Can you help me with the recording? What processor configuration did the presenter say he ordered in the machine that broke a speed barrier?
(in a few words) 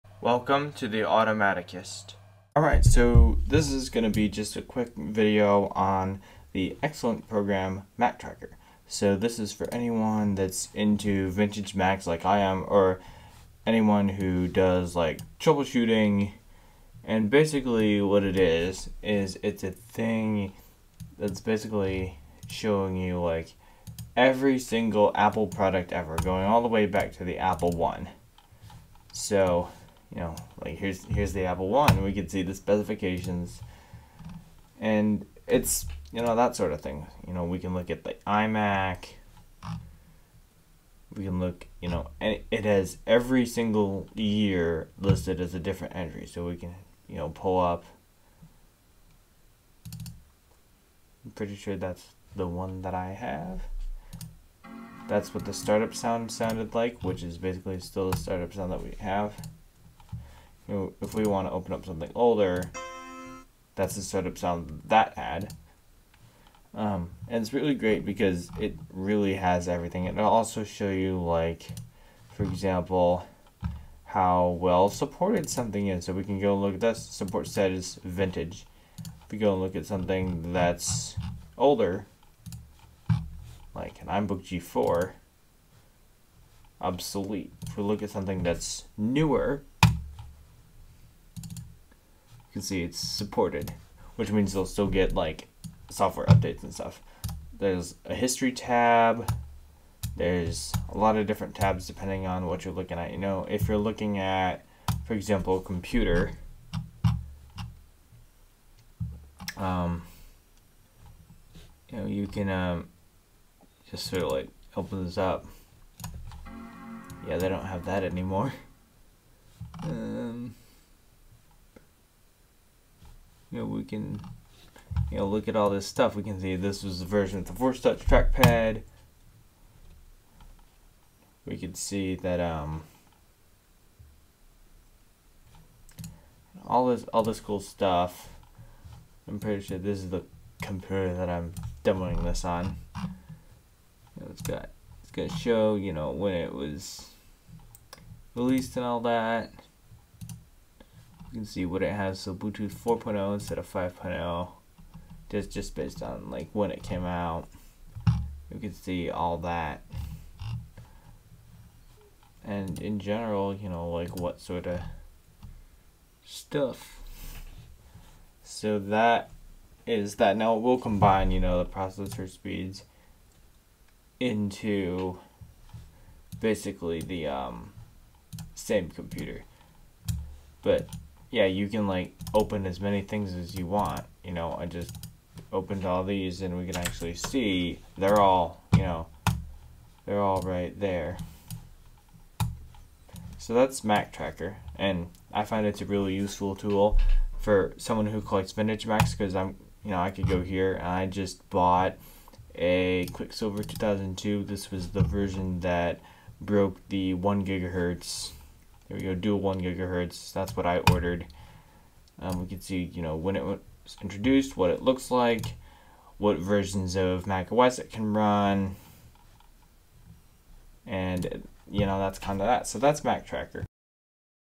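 Dual 1 gigahertz.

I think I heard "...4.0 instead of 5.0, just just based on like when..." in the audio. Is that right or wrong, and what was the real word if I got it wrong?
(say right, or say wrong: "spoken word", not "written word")
right.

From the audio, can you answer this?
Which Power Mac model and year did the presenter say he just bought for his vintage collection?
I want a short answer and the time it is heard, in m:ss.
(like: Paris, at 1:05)
Quicksilver 2002, at 3:23.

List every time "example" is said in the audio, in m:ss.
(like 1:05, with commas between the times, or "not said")
1:12, 1:45.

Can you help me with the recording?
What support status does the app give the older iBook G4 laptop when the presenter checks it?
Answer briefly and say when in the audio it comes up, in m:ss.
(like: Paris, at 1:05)
Obsolete, at 1:26.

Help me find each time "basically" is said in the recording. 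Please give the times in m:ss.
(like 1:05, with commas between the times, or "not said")
0:17, 0:21, 0:57, 2:56.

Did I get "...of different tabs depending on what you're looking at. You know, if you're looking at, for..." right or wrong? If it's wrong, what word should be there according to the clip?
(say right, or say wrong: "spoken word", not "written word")
right.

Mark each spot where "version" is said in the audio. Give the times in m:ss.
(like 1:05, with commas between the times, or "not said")
2:07, 3:25, 3:36.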